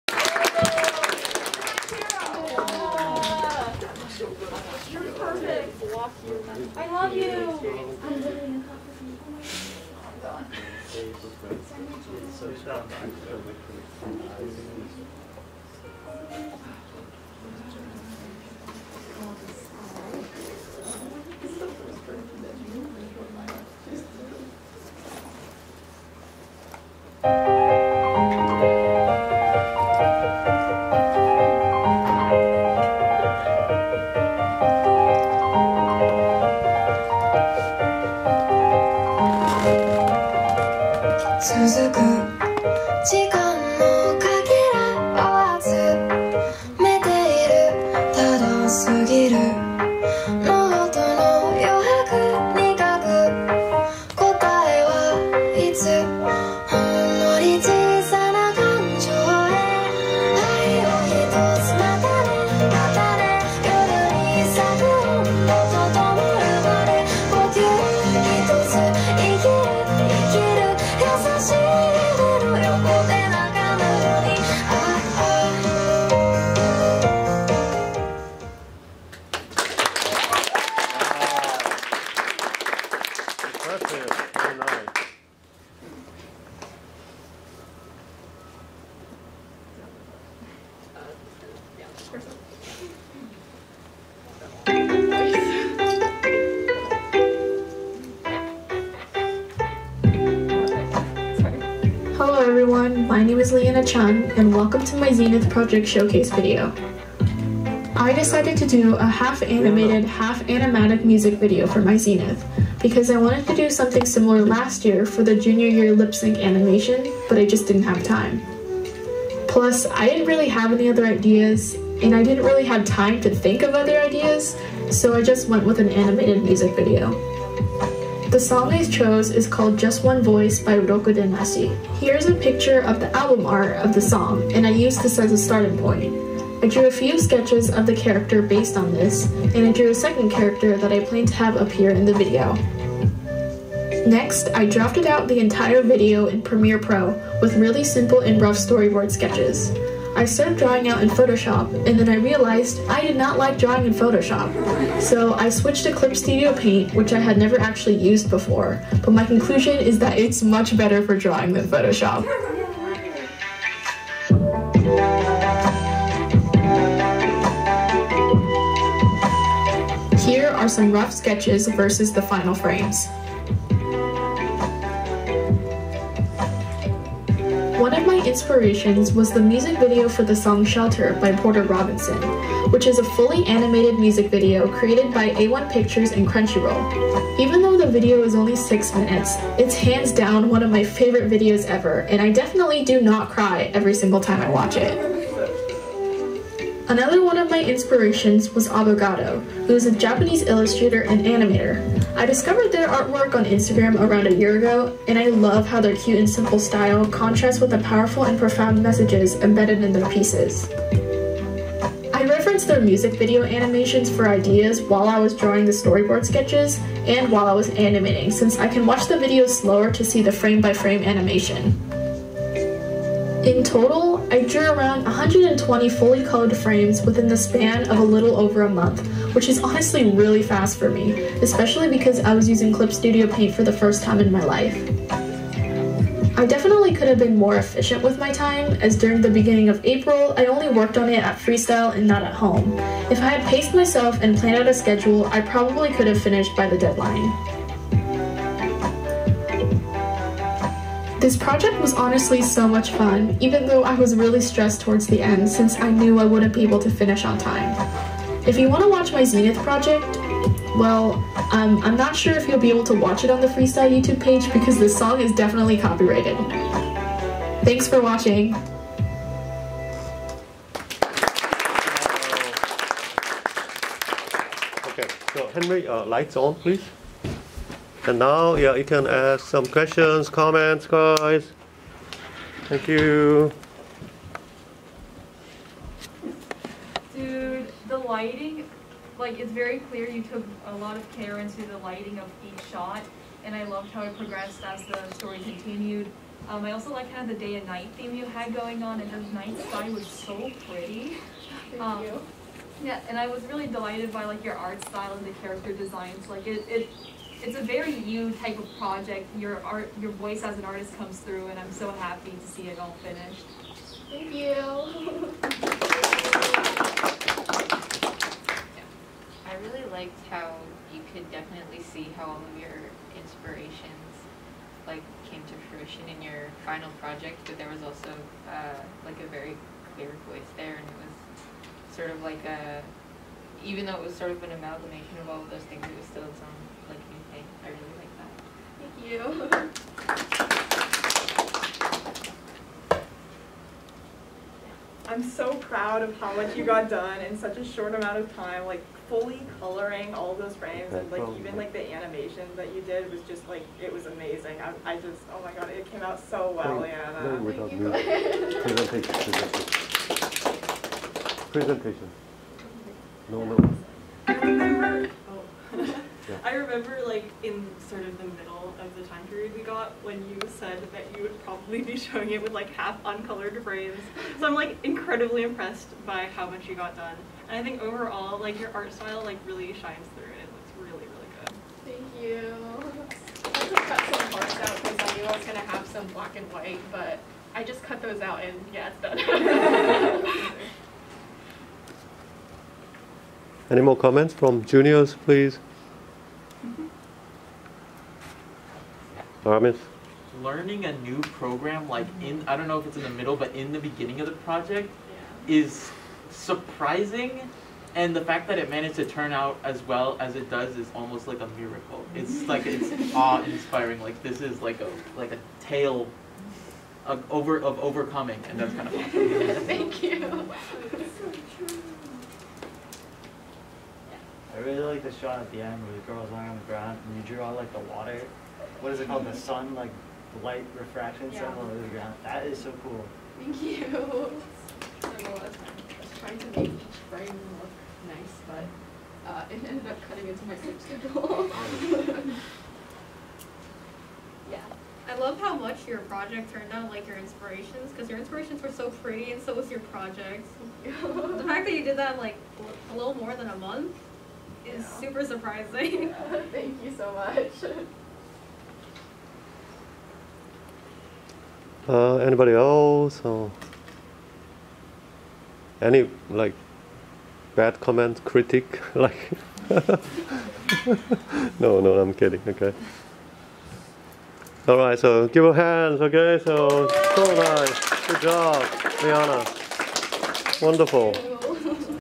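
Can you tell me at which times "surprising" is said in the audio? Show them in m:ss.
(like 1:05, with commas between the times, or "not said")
6:46, 7:35.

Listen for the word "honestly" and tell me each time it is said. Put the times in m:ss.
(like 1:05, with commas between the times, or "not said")
3:49, 4:11.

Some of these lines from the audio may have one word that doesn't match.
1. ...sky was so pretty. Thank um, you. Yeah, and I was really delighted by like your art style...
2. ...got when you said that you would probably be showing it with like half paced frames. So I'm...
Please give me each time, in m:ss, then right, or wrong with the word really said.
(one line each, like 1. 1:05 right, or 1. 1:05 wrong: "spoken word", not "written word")
1. 4:59 right
2. 6:09 wrong: "uncolored", not "paced".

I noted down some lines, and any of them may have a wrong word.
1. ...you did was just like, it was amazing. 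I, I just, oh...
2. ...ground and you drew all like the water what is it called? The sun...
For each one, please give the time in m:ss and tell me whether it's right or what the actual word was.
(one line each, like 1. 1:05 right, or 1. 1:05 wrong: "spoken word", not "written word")
1. 5:52 right
2. 7:06 right.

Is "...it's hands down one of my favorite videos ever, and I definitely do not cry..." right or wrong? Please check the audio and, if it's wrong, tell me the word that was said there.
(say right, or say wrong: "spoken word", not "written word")
right.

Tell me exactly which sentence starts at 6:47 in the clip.
And the fact that it managed to turn out as well as it does is almost like a miracle.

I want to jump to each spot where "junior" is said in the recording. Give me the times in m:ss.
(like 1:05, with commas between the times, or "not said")
1:55, 6:34.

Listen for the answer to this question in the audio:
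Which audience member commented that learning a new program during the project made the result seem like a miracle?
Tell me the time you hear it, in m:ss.
6:39.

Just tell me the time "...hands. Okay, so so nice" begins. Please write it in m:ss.
7:55.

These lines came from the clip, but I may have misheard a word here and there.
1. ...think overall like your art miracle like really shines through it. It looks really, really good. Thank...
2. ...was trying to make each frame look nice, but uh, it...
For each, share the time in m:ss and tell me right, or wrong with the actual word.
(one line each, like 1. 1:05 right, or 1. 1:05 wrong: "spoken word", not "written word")
1. 6:17 wrong: "style", not "miracle"
2. 7:15 right.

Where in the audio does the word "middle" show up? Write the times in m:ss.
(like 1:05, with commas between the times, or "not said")
6:08, 6:43.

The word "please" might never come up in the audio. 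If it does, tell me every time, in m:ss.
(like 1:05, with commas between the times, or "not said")
4:36, 6:35.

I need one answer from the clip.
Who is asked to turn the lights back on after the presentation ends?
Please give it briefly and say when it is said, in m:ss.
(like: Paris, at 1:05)
Henry, at 4:35.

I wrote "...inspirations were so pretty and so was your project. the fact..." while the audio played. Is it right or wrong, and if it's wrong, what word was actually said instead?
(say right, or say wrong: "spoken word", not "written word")
right.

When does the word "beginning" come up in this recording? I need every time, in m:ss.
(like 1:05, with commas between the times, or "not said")
3:59, 6:43.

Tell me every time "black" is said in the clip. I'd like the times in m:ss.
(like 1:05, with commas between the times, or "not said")
6:26.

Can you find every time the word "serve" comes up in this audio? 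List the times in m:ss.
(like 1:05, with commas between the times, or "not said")
not said.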